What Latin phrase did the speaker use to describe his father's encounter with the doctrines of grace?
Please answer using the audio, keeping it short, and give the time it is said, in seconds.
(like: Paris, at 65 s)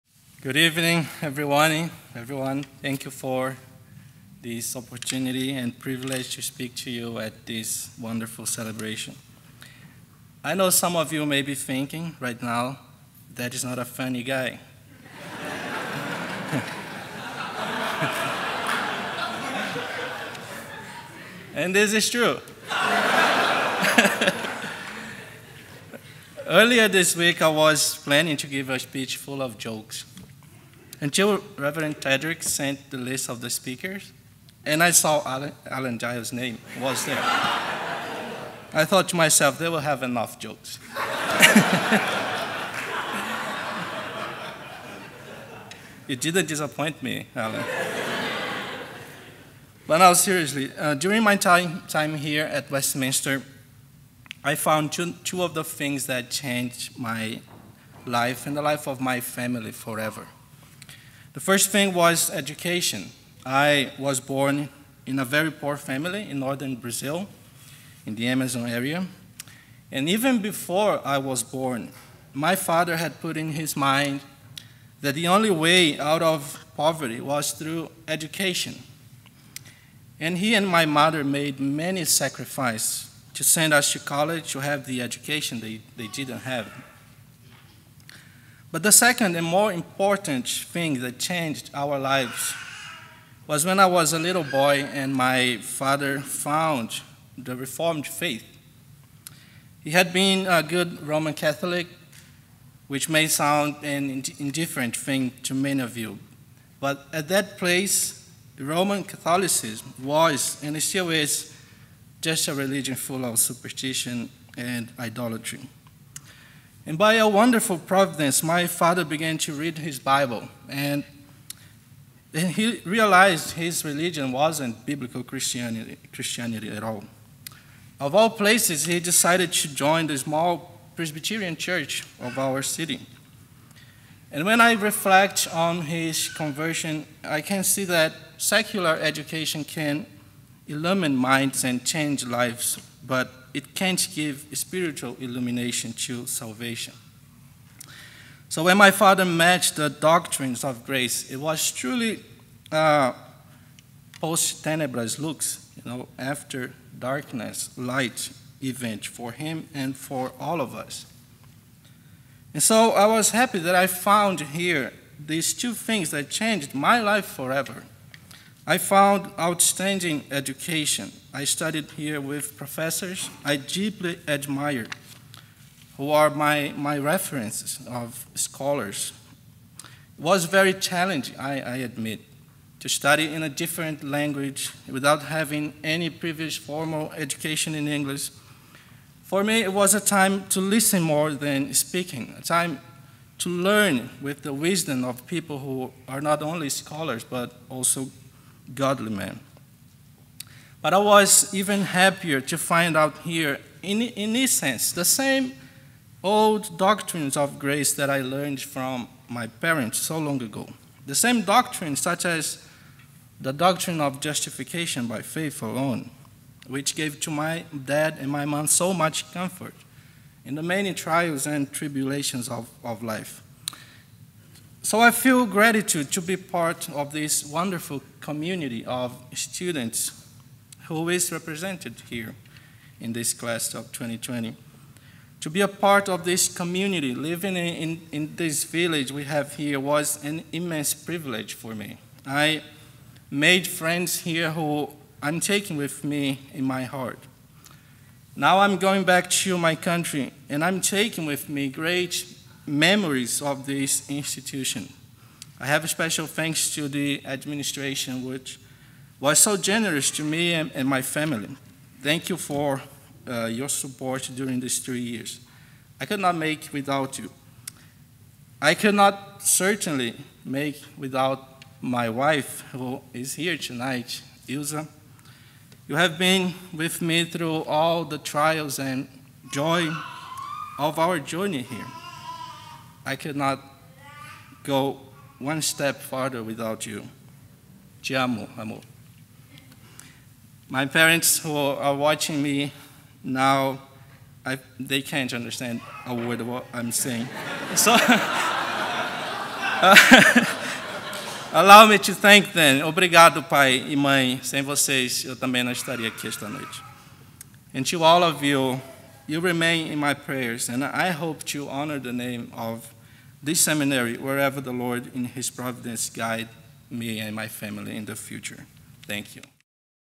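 Post tenebras lux, at 154 s.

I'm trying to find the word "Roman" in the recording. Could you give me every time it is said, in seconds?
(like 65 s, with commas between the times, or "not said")
101 s, 108 s.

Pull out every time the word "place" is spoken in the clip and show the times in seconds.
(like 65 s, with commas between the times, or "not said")
107 s, 128 s.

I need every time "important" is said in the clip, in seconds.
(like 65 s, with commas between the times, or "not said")
89 s.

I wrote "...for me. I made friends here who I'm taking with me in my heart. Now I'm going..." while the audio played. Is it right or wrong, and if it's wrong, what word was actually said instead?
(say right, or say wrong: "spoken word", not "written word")
right.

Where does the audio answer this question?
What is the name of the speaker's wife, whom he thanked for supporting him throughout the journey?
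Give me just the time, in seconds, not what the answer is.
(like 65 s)
274 s.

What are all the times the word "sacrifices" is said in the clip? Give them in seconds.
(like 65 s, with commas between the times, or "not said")
82 s.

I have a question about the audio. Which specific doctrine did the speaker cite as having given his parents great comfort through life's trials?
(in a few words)
Justification by faith alone.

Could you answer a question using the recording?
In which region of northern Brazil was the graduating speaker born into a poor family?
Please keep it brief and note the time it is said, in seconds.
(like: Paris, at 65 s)
The Amazon, at 68 s.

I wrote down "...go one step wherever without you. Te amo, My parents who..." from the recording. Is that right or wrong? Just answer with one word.
wrong.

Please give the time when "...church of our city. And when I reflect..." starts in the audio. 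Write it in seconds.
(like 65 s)
131 s.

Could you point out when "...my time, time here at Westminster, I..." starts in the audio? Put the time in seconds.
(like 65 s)
51 s.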